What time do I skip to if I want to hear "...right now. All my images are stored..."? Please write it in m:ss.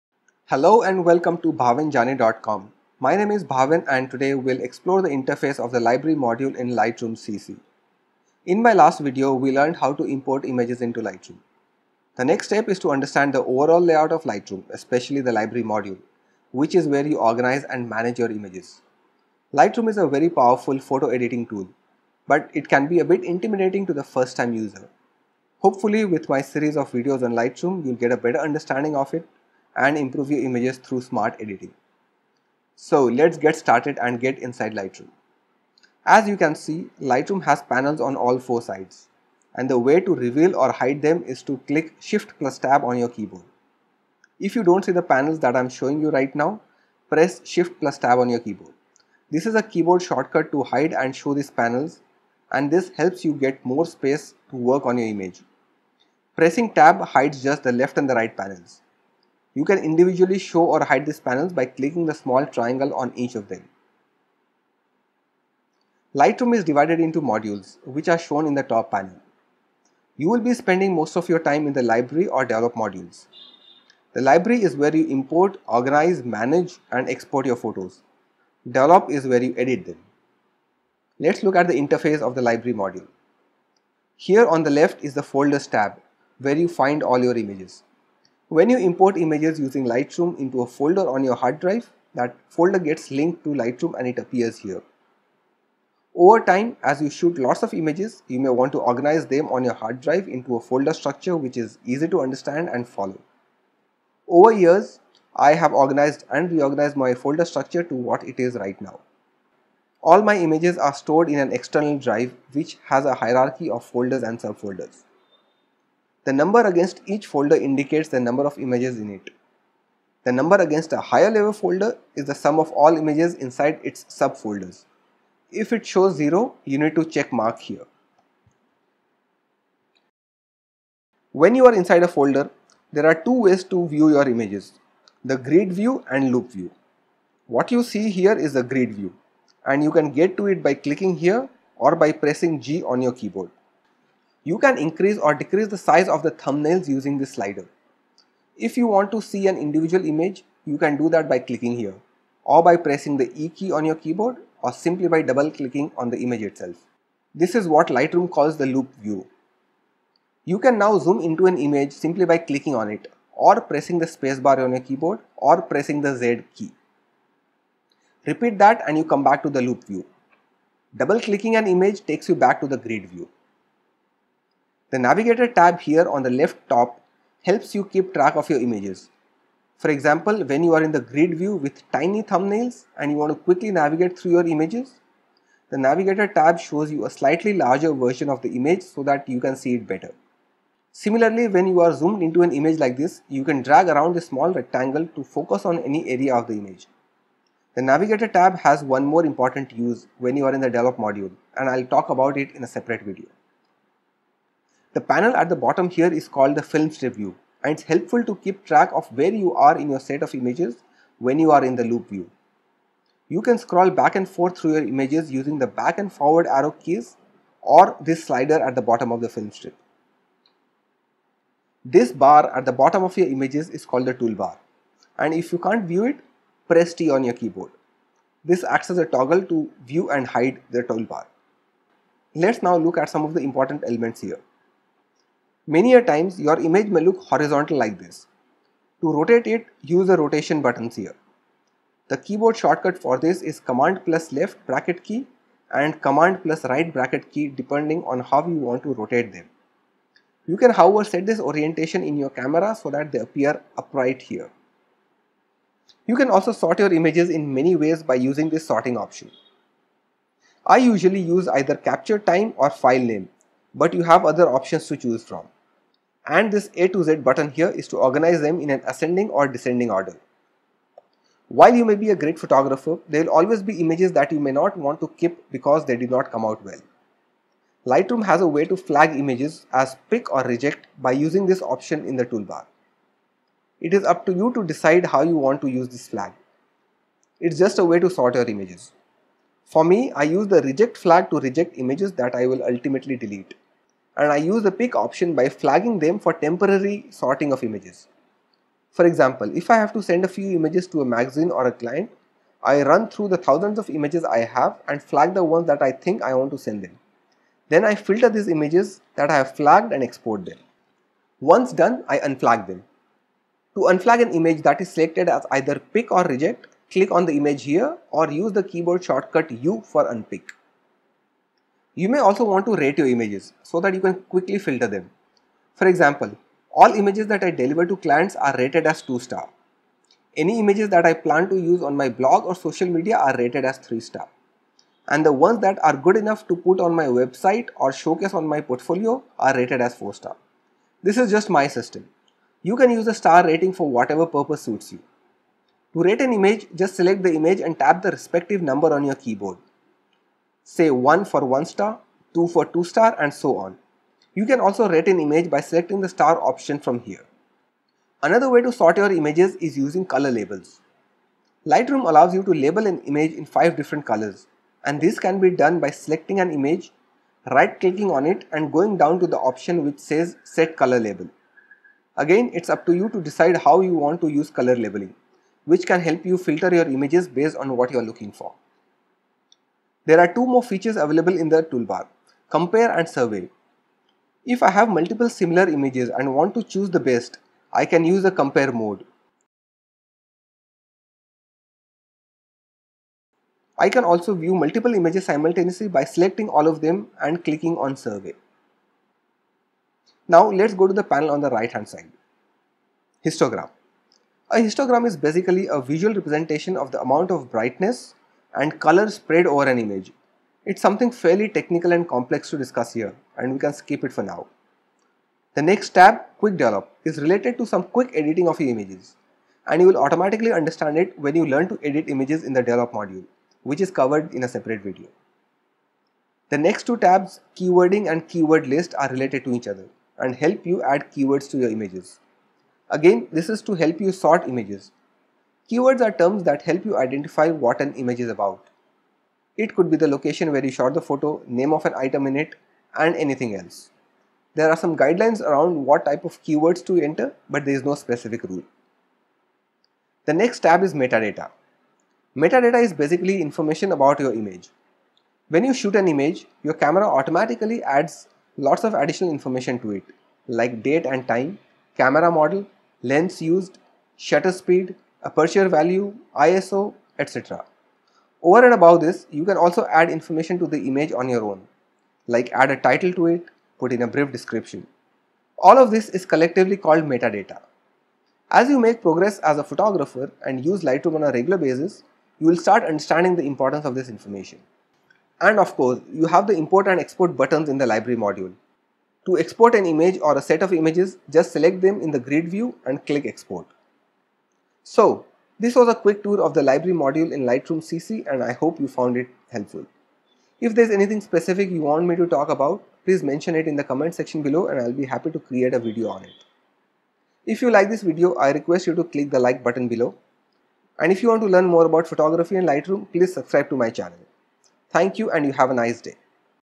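1:48.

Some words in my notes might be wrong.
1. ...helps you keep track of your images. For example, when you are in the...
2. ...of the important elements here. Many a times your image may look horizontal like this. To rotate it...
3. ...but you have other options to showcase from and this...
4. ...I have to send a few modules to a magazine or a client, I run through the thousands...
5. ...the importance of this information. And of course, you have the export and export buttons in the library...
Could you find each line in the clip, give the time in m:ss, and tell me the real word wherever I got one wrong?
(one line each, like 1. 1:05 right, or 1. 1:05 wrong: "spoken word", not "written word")
1. 2:57 right
2. 3:53 right
3. 4:23 wrong: "choose", not "showcase"
4. 4:59 wrong: "images", not "modules"
5. 8:03 wrong: "import", not "export".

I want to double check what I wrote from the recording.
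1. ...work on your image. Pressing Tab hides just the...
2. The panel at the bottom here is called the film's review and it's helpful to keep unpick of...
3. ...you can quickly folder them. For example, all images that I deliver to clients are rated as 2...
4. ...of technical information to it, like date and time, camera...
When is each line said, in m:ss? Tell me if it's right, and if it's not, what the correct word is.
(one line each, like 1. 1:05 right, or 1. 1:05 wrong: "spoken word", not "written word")
1. 0:54 right
2. 3:24 wrong: "track", not "unpick"
3. 5:23 wrong: "filter", not "folder"
4. 7:38 wrong: "additional", not "technical".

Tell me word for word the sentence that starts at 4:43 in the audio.
It is up to you to decide how you want to use this flag.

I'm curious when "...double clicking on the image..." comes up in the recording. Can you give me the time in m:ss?
2:35.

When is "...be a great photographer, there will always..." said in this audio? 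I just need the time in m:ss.
4:31.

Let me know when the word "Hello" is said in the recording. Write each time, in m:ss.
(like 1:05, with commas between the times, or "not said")
0:00.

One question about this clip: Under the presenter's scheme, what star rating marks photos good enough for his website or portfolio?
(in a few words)
4.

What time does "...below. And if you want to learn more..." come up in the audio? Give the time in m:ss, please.
8:29.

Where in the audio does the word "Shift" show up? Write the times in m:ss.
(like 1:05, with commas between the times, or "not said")
0:41, 0:47.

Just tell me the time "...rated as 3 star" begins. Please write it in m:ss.
5:33.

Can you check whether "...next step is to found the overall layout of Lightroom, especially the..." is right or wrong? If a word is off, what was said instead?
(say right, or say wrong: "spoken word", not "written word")
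wrong: "understand", not "found".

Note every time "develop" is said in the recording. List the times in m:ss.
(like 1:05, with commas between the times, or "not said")
1:12, 1:18, 3:20, 6:56, 7:02.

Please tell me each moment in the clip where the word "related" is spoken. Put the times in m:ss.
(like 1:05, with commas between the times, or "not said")
6:57, 7:09.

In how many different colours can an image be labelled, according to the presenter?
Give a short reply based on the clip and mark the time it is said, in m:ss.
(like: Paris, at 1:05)
5, at 6:03.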